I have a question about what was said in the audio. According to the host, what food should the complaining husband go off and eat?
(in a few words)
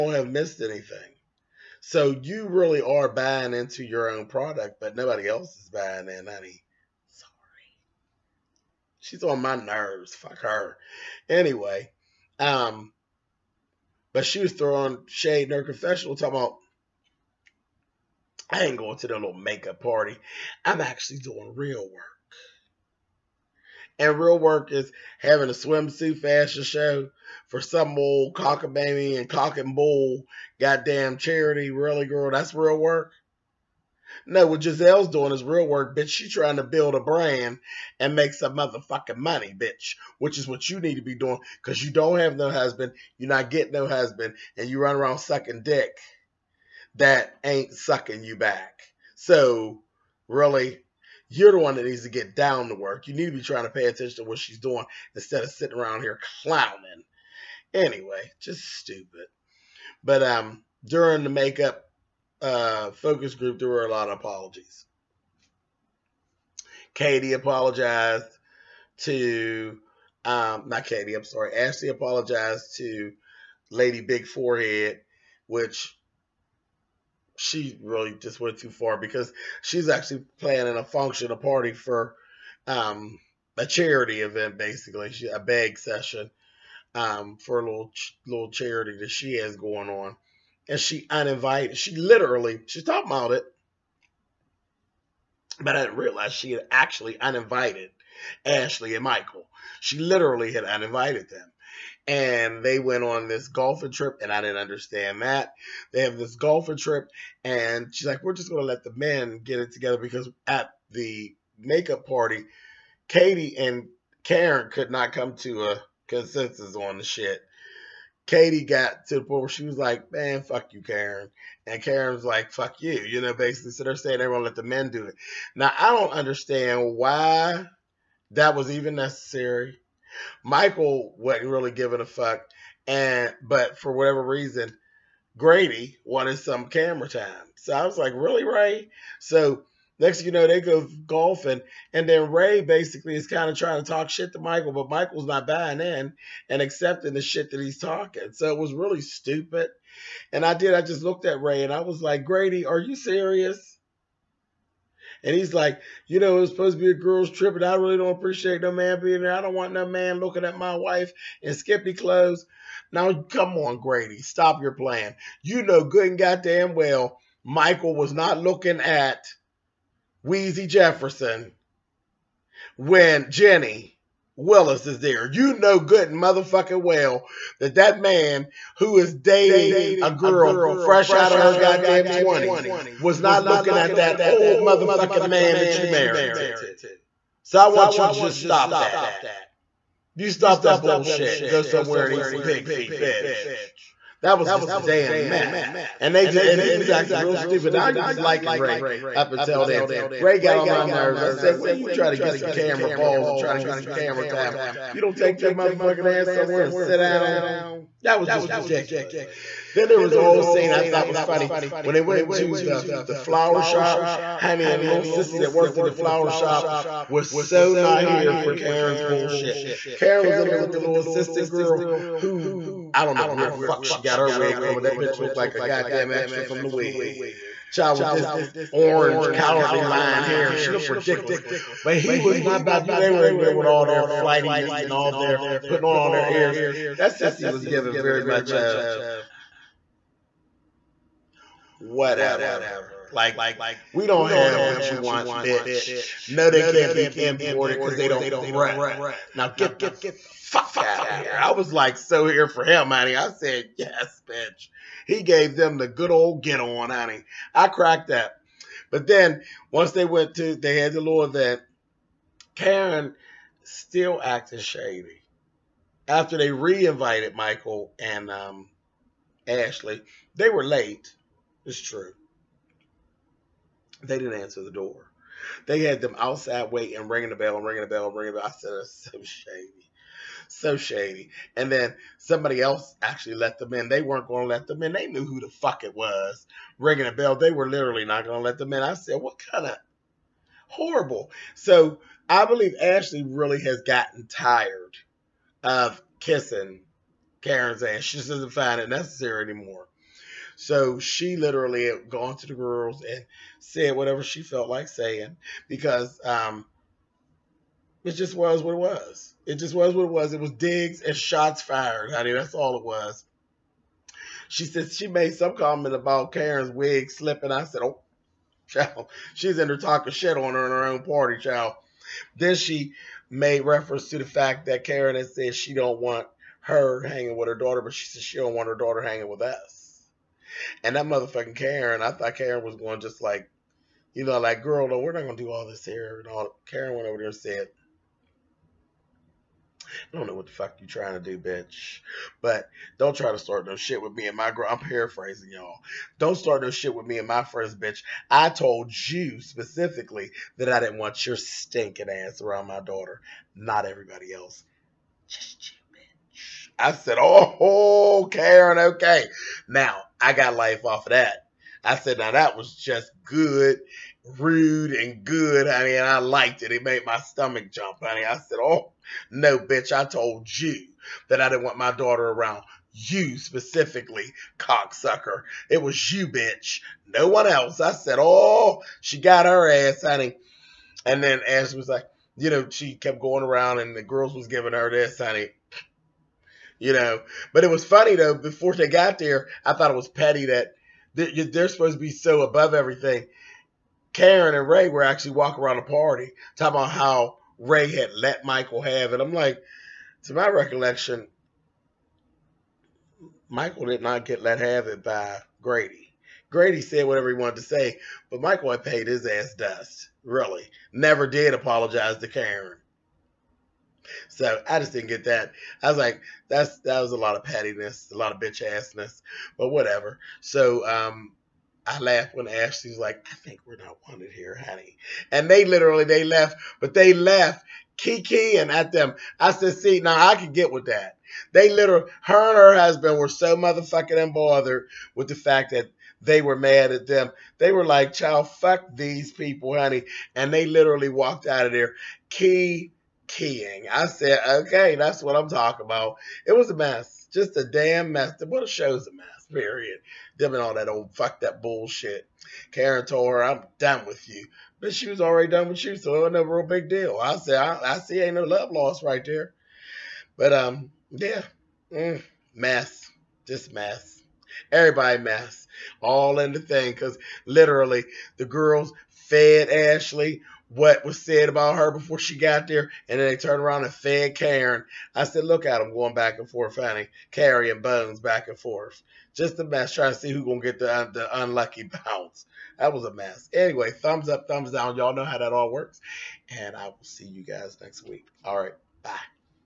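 Pig feet.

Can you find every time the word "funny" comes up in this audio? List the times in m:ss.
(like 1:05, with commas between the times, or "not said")
3:31, 6:27.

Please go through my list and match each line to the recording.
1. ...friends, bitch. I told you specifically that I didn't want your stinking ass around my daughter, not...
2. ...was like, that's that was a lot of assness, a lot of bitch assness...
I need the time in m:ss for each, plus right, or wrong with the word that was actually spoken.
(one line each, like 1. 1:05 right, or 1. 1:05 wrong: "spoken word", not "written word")
1. 5:47 right
2. 6:55 wrong: "pettiness", not "assness".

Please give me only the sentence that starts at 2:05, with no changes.
Now I don't understand why that was even necessary.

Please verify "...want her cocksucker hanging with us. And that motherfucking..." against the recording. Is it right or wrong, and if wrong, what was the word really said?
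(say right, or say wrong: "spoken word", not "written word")
wrong: "daughter", not "cocksucker".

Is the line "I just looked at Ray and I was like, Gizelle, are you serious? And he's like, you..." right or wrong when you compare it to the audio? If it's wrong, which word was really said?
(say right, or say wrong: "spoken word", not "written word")
wrong: "Grady", not "Gizelle".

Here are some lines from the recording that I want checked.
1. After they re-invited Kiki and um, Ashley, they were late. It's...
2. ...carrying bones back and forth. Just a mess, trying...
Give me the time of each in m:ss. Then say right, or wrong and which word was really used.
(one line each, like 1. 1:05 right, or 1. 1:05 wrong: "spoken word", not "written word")
1. 4:26 wrong: "Michael", not "Kiki"
2. 7:57 right.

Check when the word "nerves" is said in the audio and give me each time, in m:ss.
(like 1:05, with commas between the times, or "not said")
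0:09, 3:20.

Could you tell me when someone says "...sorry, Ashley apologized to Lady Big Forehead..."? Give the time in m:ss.
1:11.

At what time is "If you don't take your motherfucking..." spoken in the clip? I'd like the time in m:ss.
3:24.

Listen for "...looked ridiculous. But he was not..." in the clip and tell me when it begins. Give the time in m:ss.
3:50.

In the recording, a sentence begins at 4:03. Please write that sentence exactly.
Like, we don't have what you want, bitch.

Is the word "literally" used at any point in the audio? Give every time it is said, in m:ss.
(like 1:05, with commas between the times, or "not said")
1:31, 1:39, 4:47, 5:01, 7:05, 7:11, 7:20, 7:47.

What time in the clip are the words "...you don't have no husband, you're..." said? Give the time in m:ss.
0:41.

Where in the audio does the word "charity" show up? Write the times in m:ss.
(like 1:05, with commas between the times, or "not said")
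0:31, 1:23, 1:28.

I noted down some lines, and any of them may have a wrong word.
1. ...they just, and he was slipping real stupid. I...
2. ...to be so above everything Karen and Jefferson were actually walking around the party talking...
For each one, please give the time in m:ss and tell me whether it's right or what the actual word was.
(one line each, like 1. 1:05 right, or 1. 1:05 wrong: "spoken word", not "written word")
1. 3:16 wrong: "acting", not "slipping"
2. 6:31 wrong: "Ray", not "Jefferson".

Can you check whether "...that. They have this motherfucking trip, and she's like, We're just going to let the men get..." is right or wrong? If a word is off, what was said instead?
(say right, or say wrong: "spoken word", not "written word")
wrong: "golfing", not "motherfucking".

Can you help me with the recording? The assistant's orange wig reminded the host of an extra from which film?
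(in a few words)
The Wiz.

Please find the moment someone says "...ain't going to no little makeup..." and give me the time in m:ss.
0:18.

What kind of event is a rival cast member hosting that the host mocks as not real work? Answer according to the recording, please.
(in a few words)
Swimsuit fashion show.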